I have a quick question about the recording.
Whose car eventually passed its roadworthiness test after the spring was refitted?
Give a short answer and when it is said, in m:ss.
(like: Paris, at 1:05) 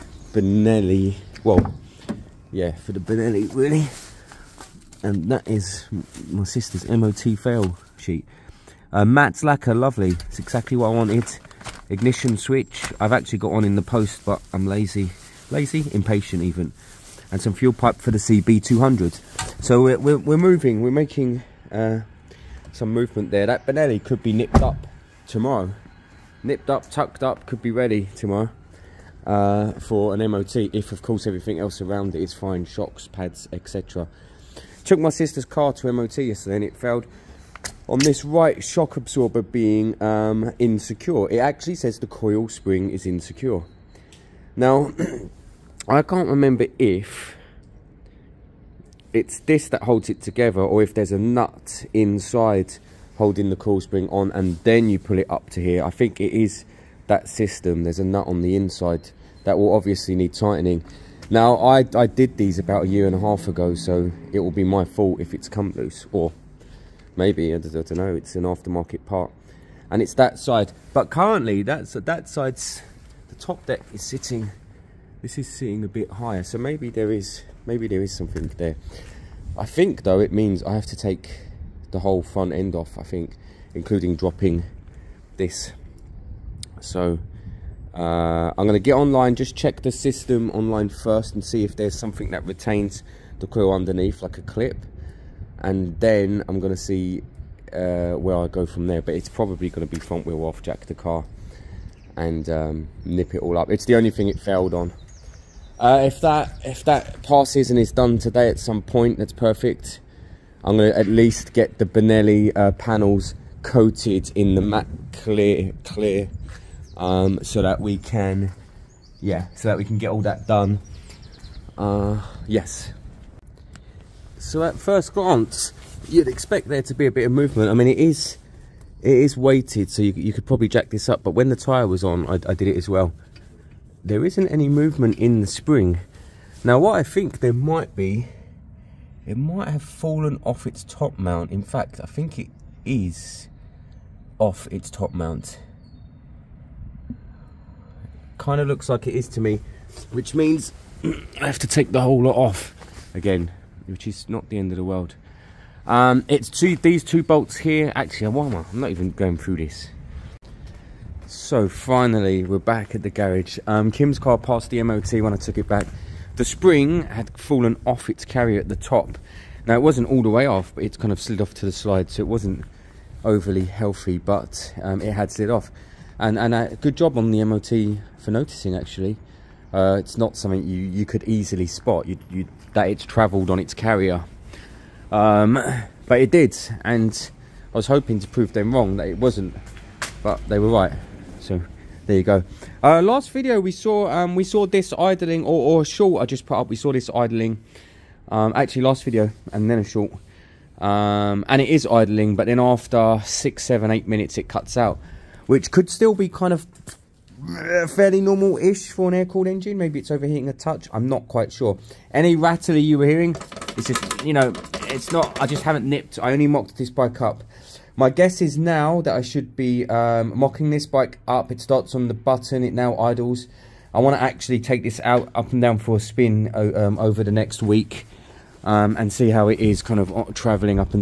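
Kim's, at 2:43.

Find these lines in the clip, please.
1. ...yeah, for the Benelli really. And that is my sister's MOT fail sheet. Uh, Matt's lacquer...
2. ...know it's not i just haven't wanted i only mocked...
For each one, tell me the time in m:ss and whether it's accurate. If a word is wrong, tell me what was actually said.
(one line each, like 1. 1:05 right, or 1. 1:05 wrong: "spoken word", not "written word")
1. 0:02 right
2. 3:34 wrong: "nipped", not "wanted".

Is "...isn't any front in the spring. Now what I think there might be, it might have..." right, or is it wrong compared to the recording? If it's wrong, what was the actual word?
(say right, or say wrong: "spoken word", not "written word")
wrong: "movement", not "front".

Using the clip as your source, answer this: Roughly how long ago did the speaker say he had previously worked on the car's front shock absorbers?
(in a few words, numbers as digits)
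A year and a half.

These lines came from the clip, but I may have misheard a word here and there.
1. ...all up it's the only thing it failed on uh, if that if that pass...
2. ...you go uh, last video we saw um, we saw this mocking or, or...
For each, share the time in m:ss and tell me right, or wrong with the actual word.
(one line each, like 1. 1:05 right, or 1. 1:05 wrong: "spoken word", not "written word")
1. 1:43 right
2. 3:12 wrong: "idling", not "mocking".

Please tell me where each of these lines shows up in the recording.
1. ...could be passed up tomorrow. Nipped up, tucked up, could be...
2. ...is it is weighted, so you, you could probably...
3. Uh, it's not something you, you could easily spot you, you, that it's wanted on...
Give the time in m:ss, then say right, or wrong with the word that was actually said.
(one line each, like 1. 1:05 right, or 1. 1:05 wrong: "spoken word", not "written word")
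1. 0:24 wrong: "nipped", not "passed"
2. 2:07 right
3. 2:59 wrong: "travelled", not "wanted".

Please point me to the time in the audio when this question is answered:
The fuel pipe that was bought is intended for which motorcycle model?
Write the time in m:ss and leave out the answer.
0:18.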